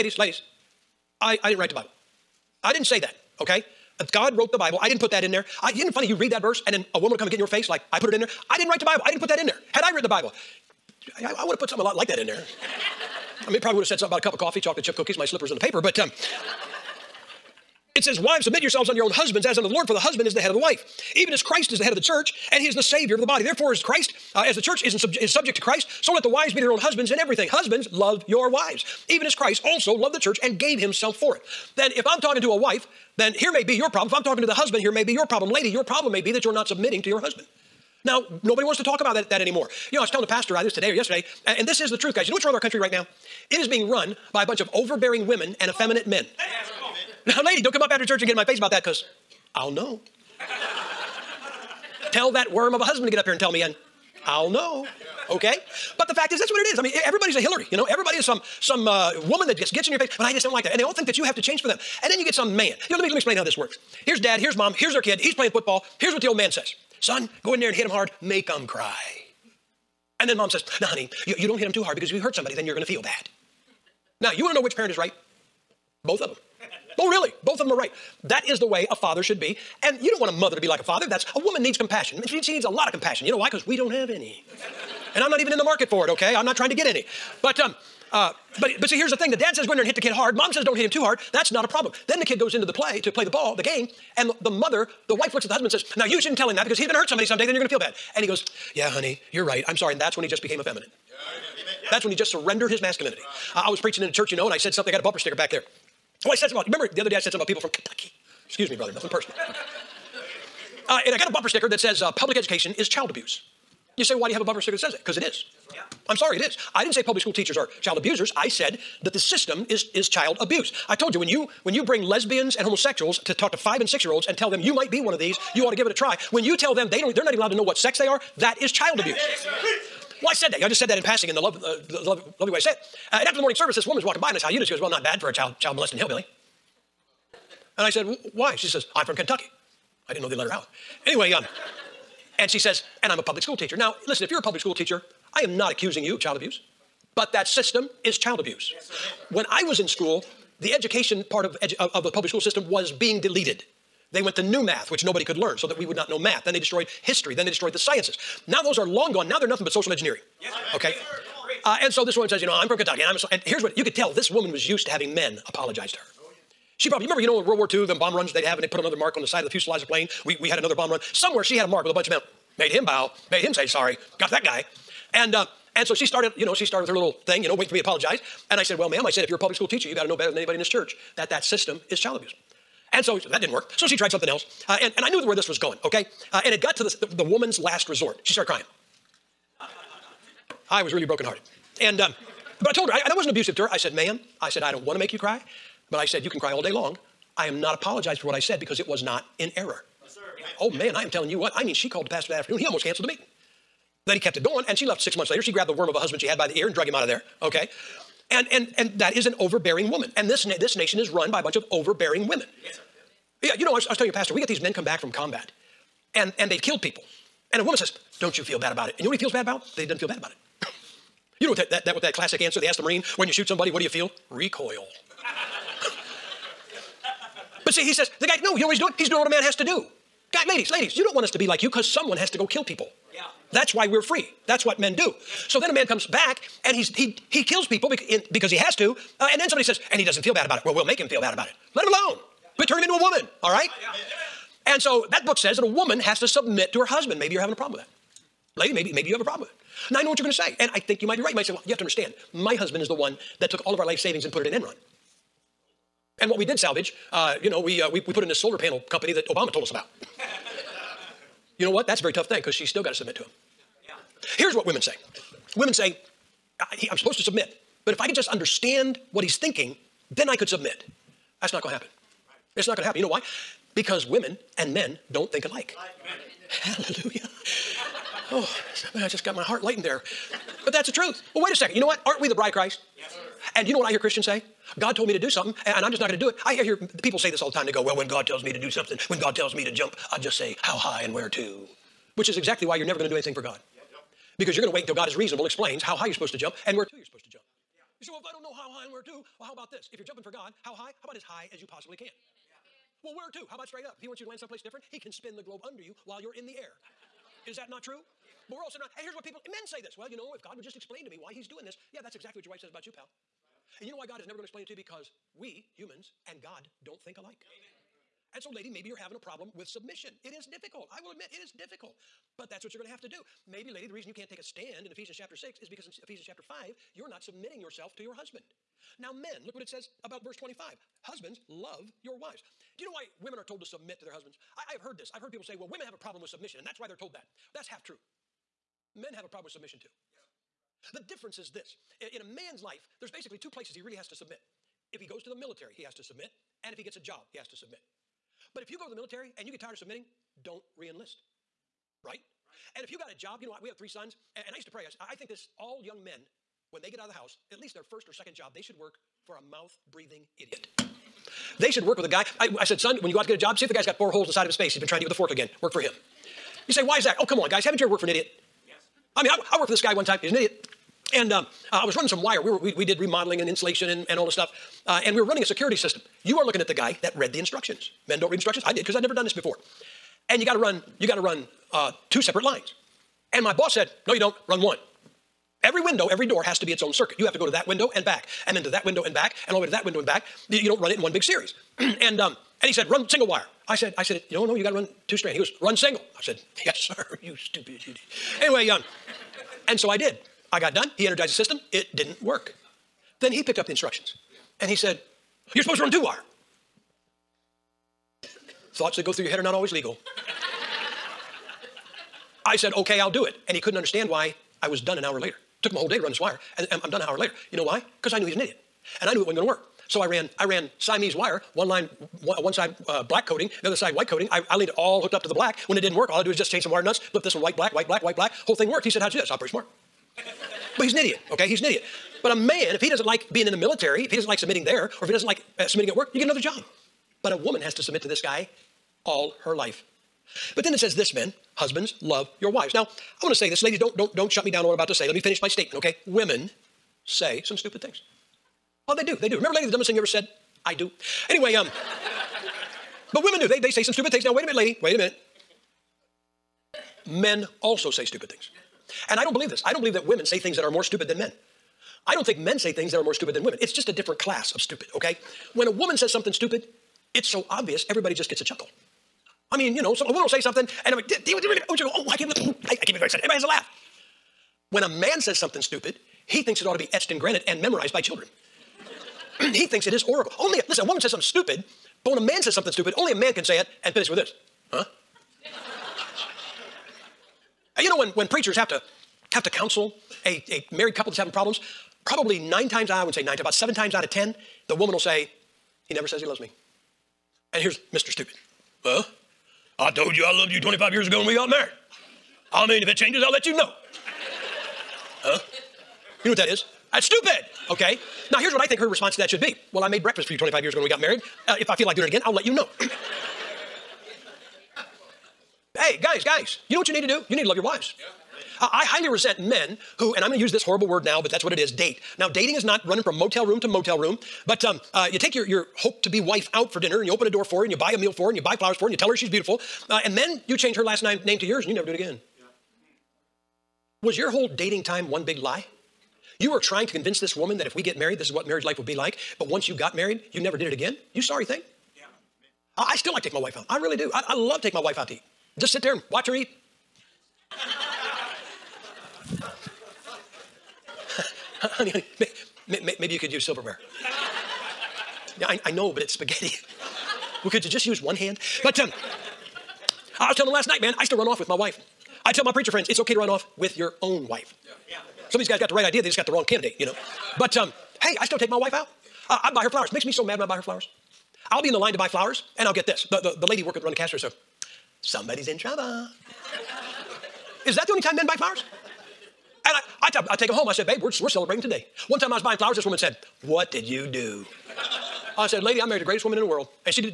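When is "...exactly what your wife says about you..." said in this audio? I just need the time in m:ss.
5:12.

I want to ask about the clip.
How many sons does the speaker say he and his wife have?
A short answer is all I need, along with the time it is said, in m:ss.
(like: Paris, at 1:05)
3, at 5:53.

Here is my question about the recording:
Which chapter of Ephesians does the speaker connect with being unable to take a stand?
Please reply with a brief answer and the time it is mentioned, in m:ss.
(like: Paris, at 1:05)
Chapter 6, at 5:24.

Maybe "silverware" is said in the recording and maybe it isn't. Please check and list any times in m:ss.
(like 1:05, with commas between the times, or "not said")
9:13.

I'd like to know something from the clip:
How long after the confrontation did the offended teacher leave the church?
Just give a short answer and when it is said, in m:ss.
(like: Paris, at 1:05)
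Six months, at 3:24.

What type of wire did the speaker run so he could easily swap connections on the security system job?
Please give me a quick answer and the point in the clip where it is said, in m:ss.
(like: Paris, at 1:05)
Siamese wire, at 7:00.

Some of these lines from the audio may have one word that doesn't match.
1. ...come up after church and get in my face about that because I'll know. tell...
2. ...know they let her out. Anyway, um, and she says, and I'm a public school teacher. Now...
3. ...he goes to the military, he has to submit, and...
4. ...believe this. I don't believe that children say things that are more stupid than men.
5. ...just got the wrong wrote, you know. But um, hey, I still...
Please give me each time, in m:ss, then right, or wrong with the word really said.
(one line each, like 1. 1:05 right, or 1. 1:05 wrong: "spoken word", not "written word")
1. 0:47 right
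2. 2:20 right
3. 5:45 right
4. 7:39 wrong: "women", not "children"
5. 9:26 wrong: "candidate", not "wrote".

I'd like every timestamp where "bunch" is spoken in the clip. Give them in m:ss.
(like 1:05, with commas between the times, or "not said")
0:44, 2:51, 3:31.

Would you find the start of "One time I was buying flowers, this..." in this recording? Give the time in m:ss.
9:42.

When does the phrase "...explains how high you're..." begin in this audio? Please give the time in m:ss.
4:55.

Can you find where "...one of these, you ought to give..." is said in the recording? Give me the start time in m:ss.
2:05.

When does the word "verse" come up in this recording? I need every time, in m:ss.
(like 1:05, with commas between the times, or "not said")
0:06, 5:30.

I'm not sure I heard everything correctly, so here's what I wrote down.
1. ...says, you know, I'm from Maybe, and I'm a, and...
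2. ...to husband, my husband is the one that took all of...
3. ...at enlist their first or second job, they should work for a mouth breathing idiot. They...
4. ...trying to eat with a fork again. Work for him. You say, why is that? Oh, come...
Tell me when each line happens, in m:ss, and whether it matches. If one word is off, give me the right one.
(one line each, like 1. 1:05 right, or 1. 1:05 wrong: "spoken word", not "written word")
1. 2:42 wrong: "Kentucky", not "Maybe"
2. 4:11 wrong: "understand", not "husband"
3. 5:57 wrong: "least", not "enlist"
4. 6:04 right.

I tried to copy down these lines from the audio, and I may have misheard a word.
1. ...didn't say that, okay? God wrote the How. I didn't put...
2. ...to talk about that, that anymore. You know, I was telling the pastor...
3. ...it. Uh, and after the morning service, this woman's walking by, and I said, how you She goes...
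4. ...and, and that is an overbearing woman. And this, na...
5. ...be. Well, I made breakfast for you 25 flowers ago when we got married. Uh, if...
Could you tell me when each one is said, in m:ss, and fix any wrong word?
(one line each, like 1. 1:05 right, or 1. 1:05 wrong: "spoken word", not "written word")
1. 0:02 wrong: "Bible", not "How"
2. 0:38 right
3. 2:12 right
4. 3:28 right
5. 8:29 wrong: "years", not "flowers".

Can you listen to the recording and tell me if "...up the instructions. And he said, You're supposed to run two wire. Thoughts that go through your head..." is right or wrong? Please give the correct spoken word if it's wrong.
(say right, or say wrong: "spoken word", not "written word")
right.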